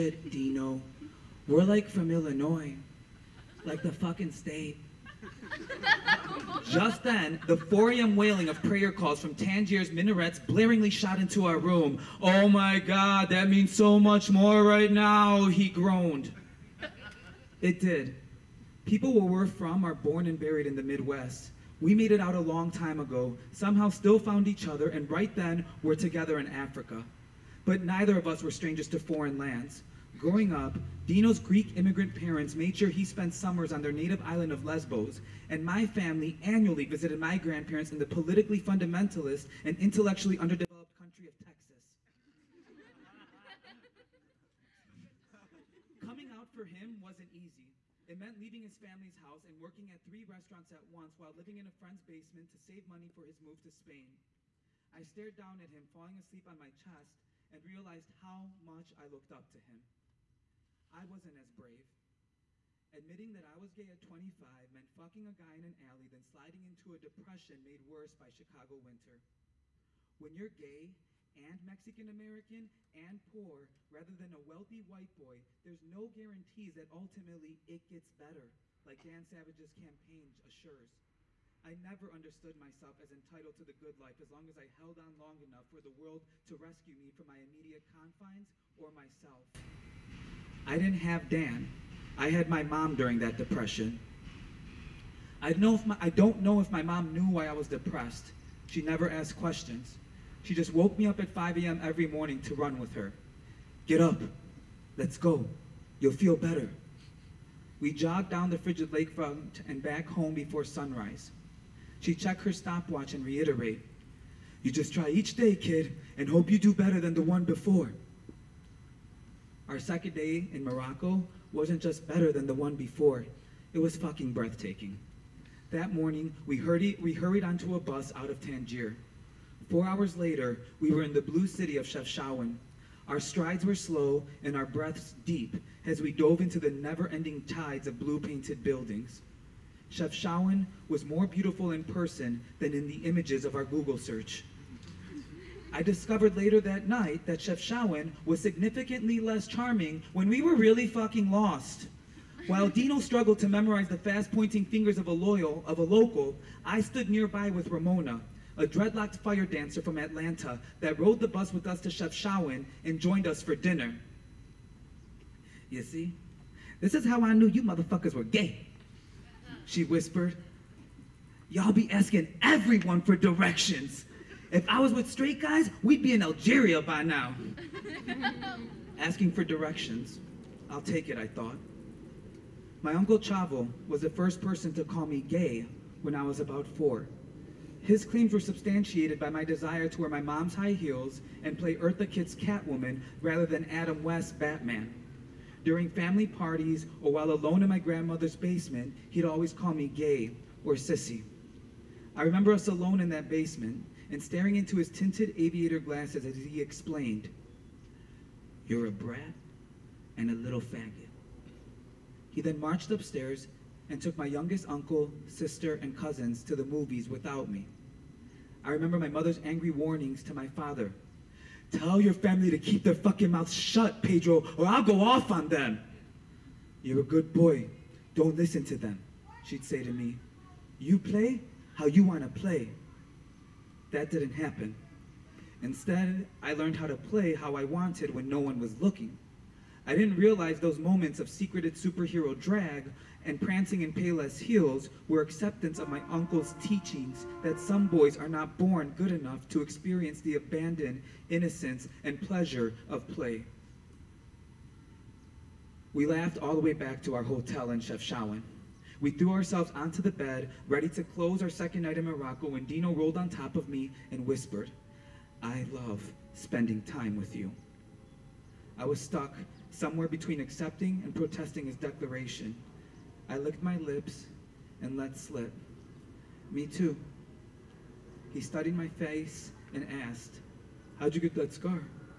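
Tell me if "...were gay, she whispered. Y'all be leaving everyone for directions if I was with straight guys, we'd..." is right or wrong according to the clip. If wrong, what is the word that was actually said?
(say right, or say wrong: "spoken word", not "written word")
wrong: "asking", not "leaving".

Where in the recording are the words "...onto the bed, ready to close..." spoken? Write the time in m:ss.
4:19.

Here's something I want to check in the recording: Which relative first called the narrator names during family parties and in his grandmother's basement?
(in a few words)
Uncle Chavo.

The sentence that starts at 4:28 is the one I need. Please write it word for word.
I was stuck somewhere between accepting and protesting his declaration.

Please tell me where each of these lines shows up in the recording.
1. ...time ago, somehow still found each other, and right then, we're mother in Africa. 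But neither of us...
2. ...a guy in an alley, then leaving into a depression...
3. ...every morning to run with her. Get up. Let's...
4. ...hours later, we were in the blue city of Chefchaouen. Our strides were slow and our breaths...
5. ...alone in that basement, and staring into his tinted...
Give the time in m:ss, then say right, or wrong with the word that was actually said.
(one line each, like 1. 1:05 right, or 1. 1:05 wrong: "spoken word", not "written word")
1. 0:22 wrong: "together", not "mother"
2. 1:05 wrong: "sliding", not "leaving"
3. 1:41 right
4. 2:09 right
5. 3:22 right.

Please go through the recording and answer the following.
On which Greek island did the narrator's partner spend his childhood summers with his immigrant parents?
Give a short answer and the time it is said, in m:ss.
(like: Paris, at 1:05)
Lesbos, at 0:34.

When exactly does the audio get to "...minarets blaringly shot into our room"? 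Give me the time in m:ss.
0:09.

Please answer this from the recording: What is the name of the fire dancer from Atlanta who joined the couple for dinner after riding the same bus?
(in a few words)
Ramona.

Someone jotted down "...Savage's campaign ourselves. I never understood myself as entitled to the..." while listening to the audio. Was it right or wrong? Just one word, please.
wrong.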